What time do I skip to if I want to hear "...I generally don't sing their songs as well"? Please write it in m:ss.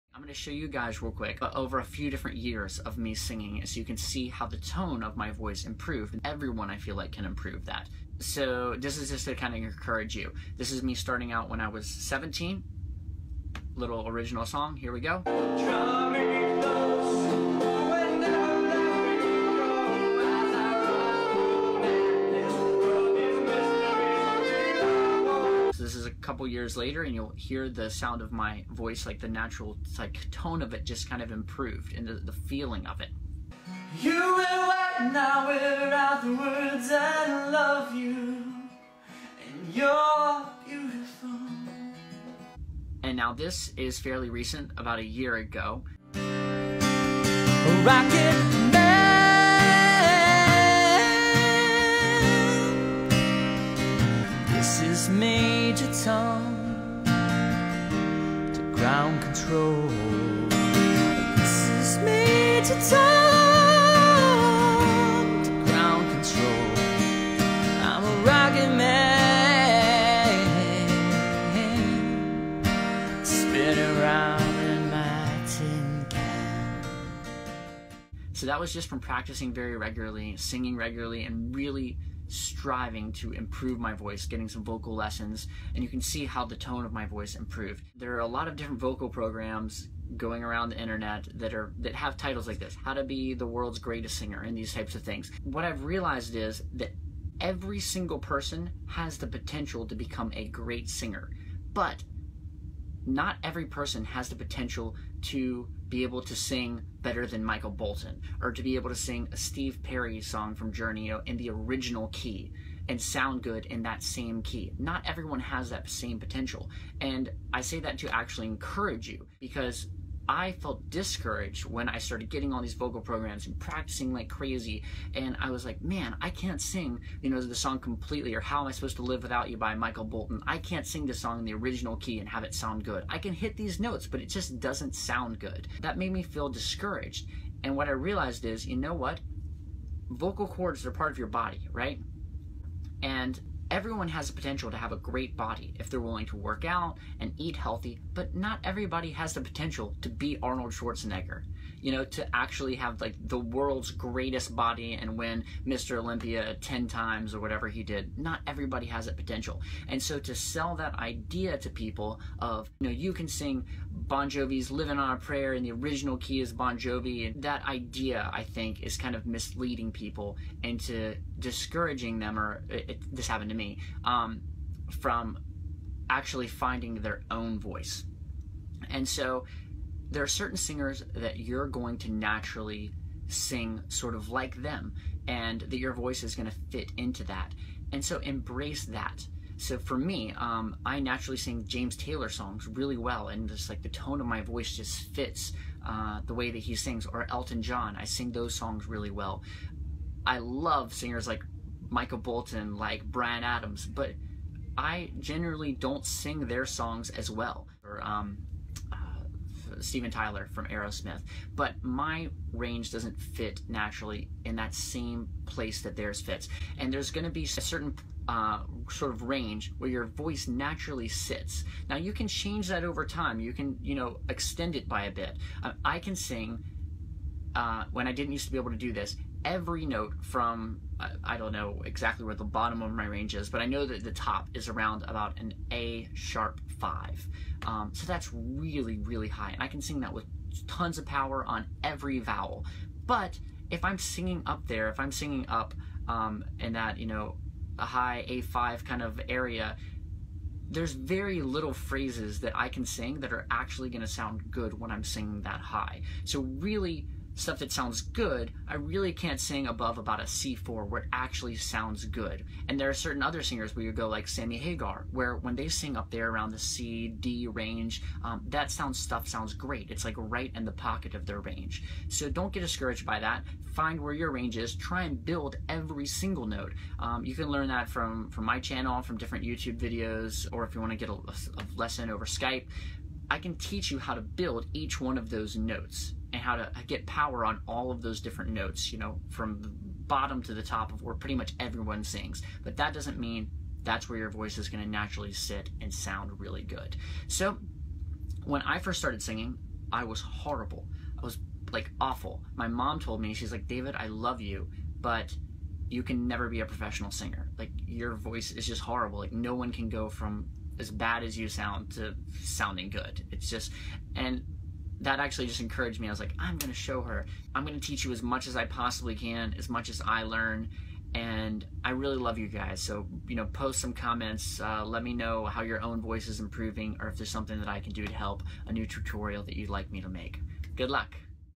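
3:24.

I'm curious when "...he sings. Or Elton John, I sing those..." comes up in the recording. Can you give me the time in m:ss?
3:16.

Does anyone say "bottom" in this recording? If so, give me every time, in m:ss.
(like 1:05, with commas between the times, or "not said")
3:52, 4:49.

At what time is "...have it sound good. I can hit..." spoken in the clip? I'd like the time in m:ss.
2:12.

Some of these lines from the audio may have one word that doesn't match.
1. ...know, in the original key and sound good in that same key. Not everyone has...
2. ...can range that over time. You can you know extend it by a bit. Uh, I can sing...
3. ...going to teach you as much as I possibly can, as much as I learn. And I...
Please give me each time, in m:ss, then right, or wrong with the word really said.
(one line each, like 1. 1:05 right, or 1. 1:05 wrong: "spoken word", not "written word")
1. 1:51 right
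2. 3:42 wrong: "change", not "range"
3. 5:17 right.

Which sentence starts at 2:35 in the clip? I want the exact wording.
Olympia 10 times or whatever he did.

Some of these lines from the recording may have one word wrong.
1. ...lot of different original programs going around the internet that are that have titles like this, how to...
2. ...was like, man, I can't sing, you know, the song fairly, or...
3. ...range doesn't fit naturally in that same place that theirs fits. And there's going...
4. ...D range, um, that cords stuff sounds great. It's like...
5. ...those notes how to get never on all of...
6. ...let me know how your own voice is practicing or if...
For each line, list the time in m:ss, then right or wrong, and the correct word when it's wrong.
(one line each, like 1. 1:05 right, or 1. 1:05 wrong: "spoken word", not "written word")
1. 1:28 wrong: "vocal", not "original"
2. 2:05 wrong: "completely", not "fairly"
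3. 3:32 right
4. 4:27 wrong: "sounds", not "cords"
5. 4:45 wrong: "power", not "never"
6. 5:24 wrong: "improving", not "practicing".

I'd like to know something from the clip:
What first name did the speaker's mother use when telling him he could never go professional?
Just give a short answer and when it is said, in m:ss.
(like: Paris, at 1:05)
David, at 5:03.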